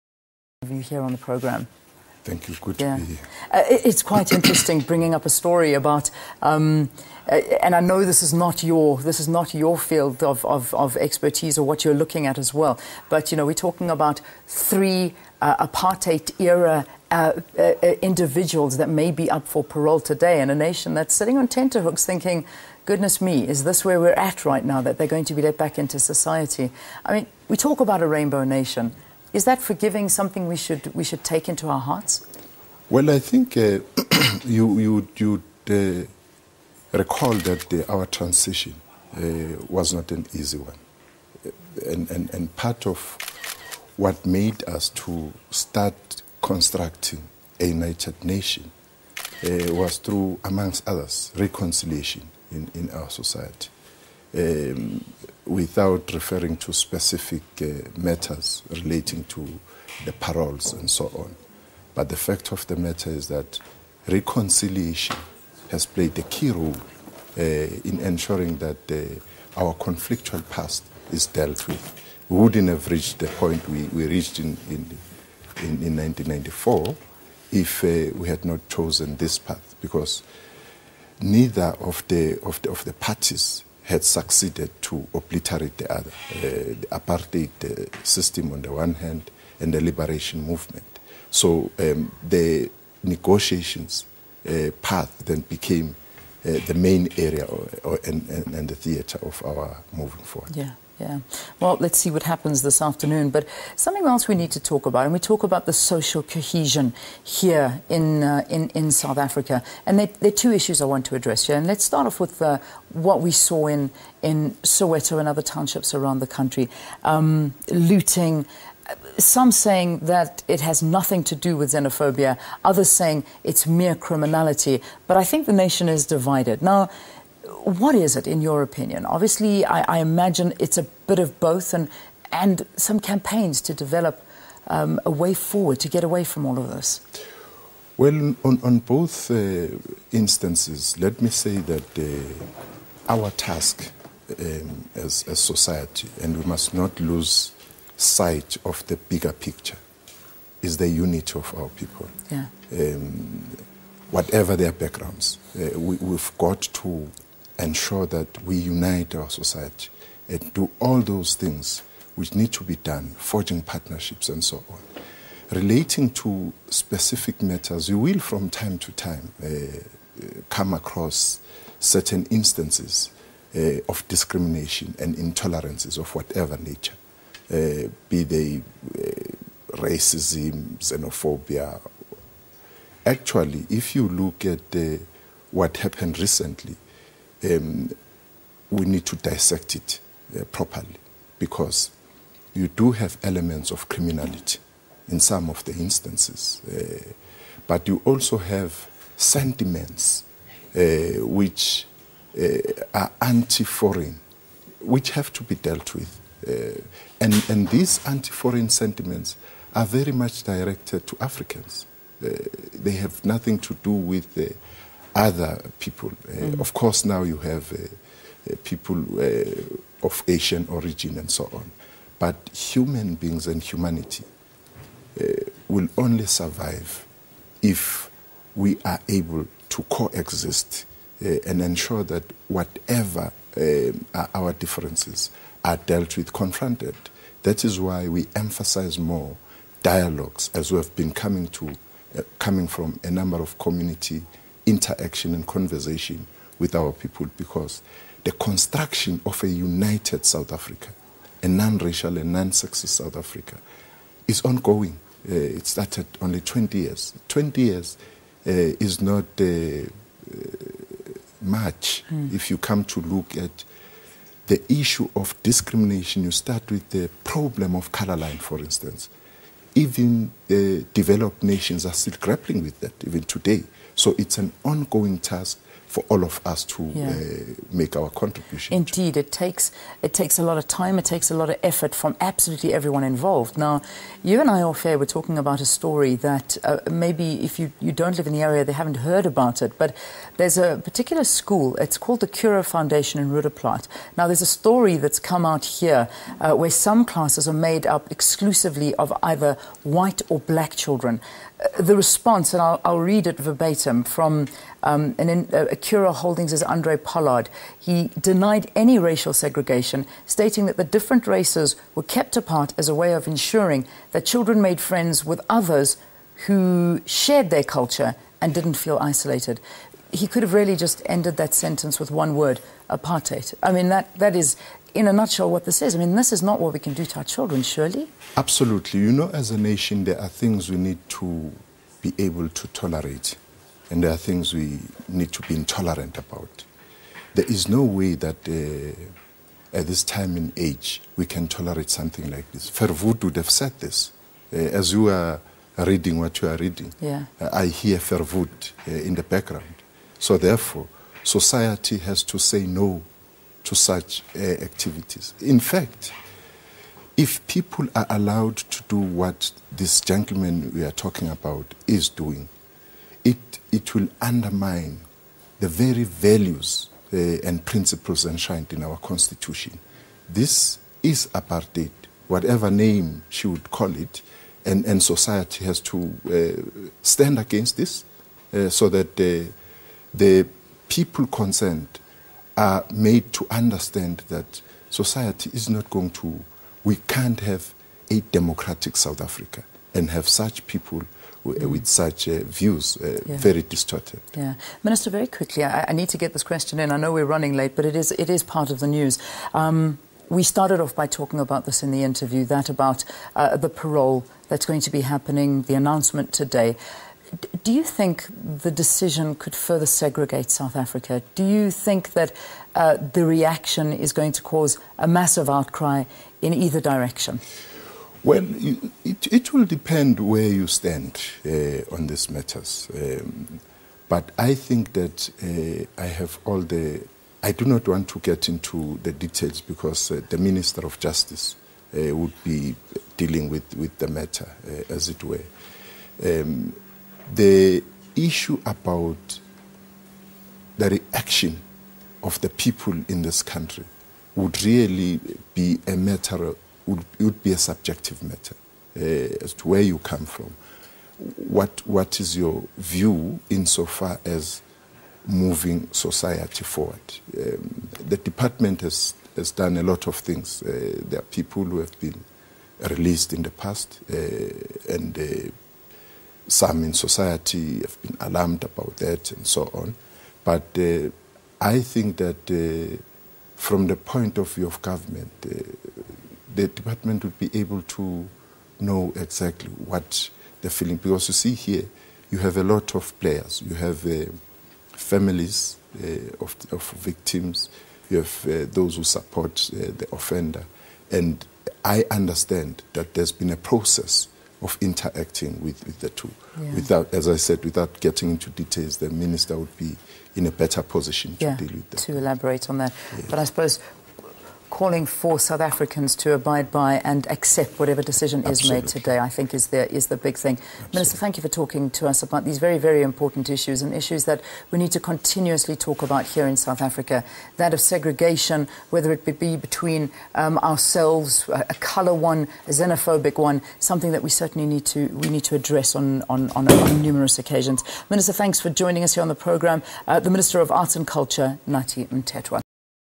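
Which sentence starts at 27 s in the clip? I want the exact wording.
I mean, we talk about a rainbow nation.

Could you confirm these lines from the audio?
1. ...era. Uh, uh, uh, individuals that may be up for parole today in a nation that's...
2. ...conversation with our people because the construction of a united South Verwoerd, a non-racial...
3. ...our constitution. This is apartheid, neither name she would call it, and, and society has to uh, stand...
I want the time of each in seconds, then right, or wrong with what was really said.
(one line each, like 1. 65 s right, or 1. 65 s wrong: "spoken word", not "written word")
1. 16 s right
2. 245 s wrong: "Africa", not "Verwoerd"
3. 368 s wrong: "whatever", not "neither".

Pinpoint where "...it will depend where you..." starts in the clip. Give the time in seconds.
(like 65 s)
419 s.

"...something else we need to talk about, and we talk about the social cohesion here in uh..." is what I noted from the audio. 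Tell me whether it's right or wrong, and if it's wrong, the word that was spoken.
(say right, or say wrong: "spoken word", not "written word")
right.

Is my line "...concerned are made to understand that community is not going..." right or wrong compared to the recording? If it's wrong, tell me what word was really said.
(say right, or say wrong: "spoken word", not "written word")
wrong: "society", not "community".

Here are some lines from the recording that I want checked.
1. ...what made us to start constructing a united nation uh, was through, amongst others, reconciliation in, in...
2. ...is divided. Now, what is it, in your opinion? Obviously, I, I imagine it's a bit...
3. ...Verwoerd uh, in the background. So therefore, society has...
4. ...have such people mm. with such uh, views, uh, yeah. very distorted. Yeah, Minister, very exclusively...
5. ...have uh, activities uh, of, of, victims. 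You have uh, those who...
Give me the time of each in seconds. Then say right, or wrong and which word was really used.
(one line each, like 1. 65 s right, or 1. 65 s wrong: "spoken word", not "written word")
1. 43 s right
2. 125 s right
3. 347 s right
4. 390 s wrong: "quickly", not "exclusively"
5. 483 s wrong: "families", not "activities".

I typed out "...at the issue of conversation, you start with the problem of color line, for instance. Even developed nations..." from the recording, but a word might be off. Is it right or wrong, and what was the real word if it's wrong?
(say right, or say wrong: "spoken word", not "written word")
wrong: "discrimination", not "conversation".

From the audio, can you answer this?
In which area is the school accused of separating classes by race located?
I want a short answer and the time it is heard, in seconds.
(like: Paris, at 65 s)
Roodeplaat, at 293 s.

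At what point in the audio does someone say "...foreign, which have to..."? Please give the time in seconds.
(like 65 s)
203 s.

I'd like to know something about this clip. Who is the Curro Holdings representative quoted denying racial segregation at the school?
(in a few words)
Andre Pollard.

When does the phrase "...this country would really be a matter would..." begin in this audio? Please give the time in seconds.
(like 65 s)
443 s.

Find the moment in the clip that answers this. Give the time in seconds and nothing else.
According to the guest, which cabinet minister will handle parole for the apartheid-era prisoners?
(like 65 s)
430 s.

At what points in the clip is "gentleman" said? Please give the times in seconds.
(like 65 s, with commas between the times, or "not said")
359 s.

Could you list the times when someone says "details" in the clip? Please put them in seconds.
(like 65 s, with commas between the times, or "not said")
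429 s, 498 s.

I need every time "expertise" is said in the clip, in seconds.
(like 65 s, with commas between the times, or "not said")
10 s.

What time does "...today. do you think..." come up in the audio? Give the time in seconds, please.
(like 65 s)
406 s.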